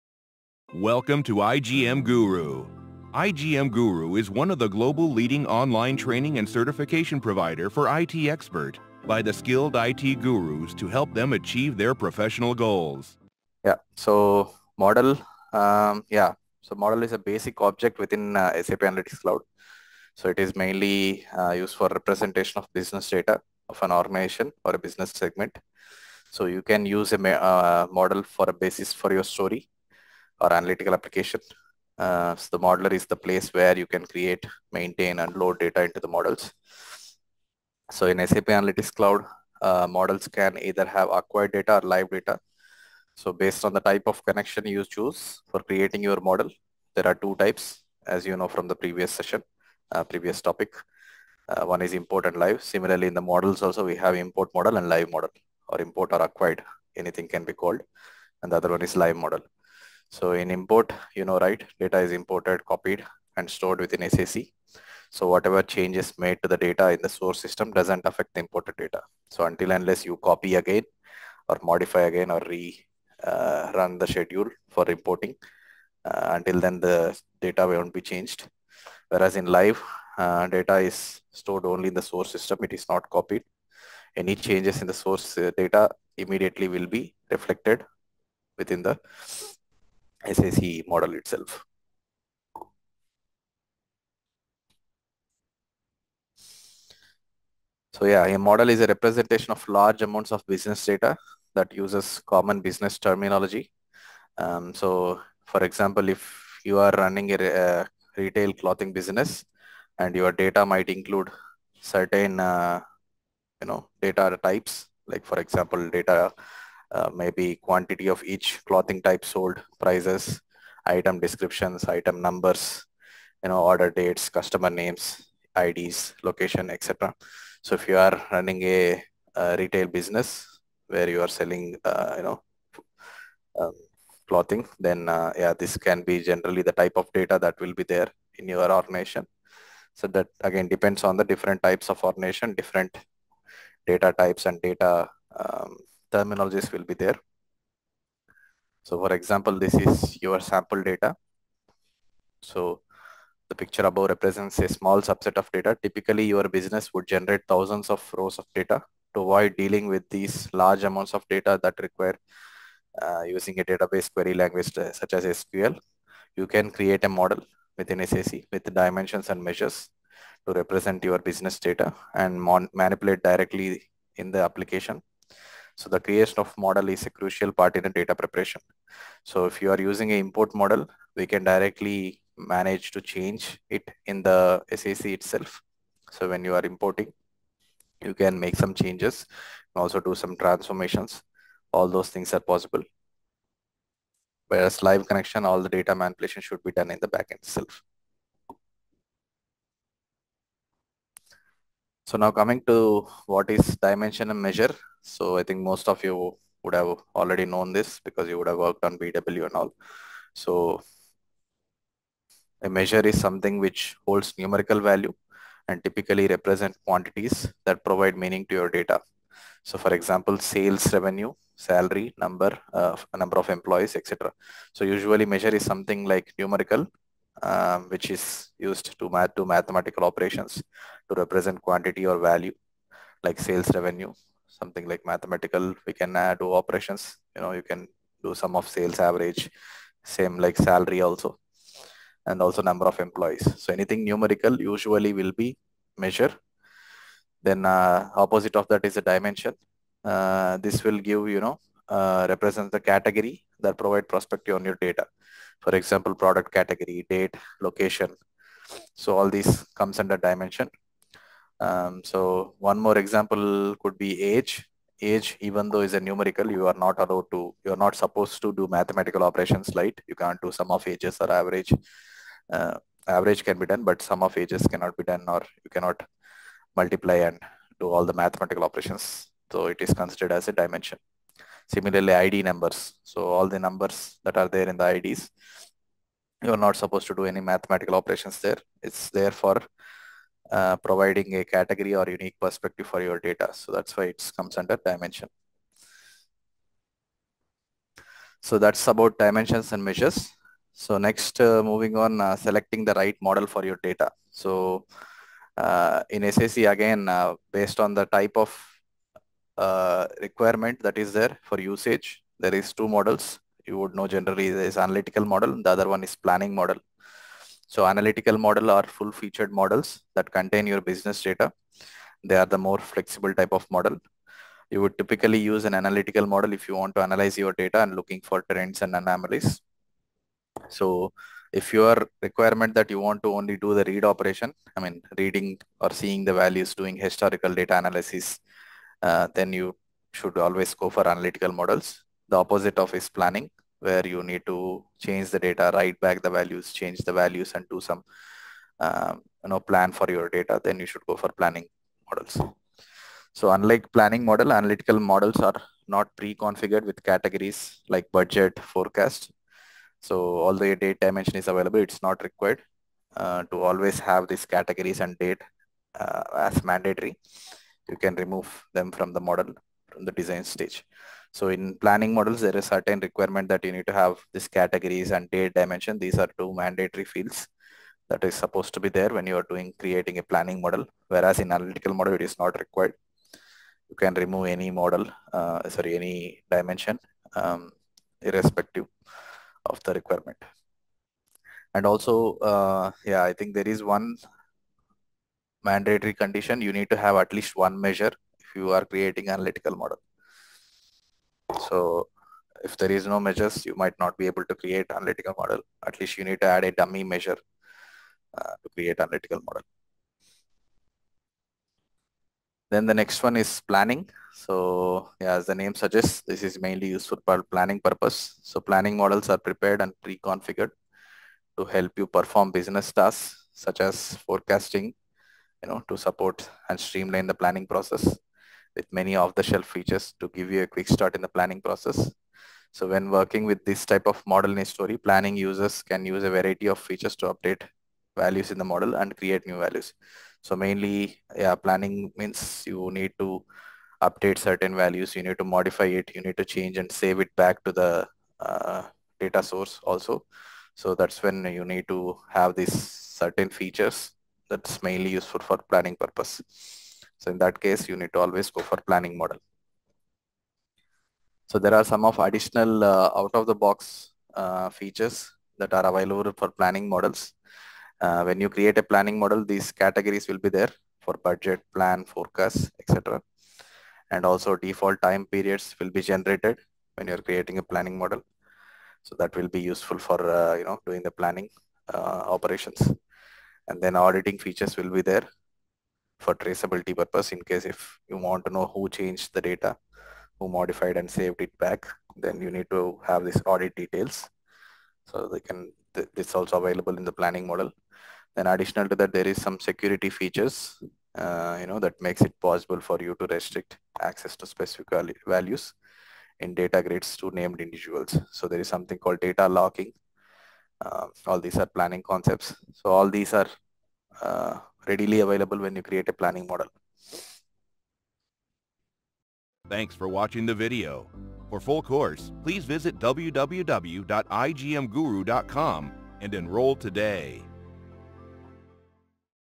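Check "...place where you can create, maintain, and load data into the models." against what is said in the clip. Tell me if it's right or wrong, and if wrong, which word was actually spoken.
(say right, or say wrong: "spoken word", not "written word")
right.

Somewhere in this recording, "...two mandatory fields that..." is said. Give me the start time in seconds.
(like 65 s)
376 s.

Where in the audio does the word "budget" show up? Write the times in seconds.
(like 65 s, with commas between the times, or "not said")
358 s, 471 s.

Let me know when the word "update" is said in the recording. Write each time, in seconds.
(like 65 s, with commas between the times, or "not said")
437 s, 444 s.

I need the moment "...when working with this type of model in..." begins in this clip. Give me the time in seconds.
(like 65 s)
432 s.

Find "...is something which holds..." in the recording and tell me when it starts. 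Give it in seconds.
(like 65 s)
213 s.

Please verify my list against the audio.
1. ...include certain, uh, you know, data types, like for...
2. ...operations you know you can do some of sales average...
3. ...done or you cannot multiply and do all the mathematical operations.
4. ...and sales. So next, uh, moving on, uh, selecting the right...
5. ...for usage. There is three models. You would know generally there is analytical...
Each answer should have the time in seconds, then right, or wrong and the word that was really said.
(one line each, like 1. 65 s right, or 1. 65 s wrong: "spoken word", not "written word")
1. 110 s right
2. 236 s right
3. 275 s right
4. 299 s wrong: "measures", not "sales"
5. 311 s wrong: "two", not "three".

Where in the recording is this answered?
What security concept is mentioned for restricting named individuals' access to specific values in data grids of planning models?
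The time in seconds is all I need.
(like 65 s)
509 s.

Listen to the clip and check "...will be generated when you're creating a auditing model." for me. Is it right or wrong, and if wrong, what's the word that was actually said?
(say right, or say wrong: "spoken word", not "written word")
wrong: "planning", not "auditing".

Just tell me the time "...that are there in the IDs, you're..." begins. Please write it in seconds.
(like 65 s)
284 s.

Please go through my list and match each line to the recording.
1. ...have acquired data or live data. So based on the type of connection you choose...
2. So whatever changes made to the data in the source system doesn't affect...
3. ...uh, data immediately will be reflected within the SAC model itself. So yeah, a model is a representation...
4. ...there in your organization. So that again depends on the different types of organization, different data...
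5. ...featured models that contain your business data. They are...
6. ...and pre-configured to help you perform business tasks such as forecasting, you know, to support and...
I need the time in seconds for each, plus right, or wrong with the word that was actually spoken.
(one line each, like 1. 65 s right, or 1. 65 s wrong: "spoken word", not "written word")
1. 40 s right
2. 65 s right
3. 85 s right
4. 137 s right
5. 319 s right
6. 419 s right.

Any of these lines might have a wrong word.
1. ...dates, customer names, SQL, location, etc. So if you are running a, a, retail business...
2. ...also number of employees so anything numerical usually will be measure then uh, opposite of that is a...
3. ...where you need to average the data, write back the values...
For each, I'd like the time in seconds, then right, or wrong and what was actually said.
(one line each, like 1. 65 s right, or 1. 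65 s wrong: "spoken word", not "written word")
1. 123 s wrong: "IDs", not "SQL"
2. 242 s right
3. 343 s wrong: "change", not "average".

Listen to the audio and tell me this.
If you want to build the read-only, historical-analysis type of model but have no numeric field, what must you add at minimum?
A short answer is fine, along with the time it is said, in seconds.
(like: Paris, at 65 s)
A dummy measure, at 406 s.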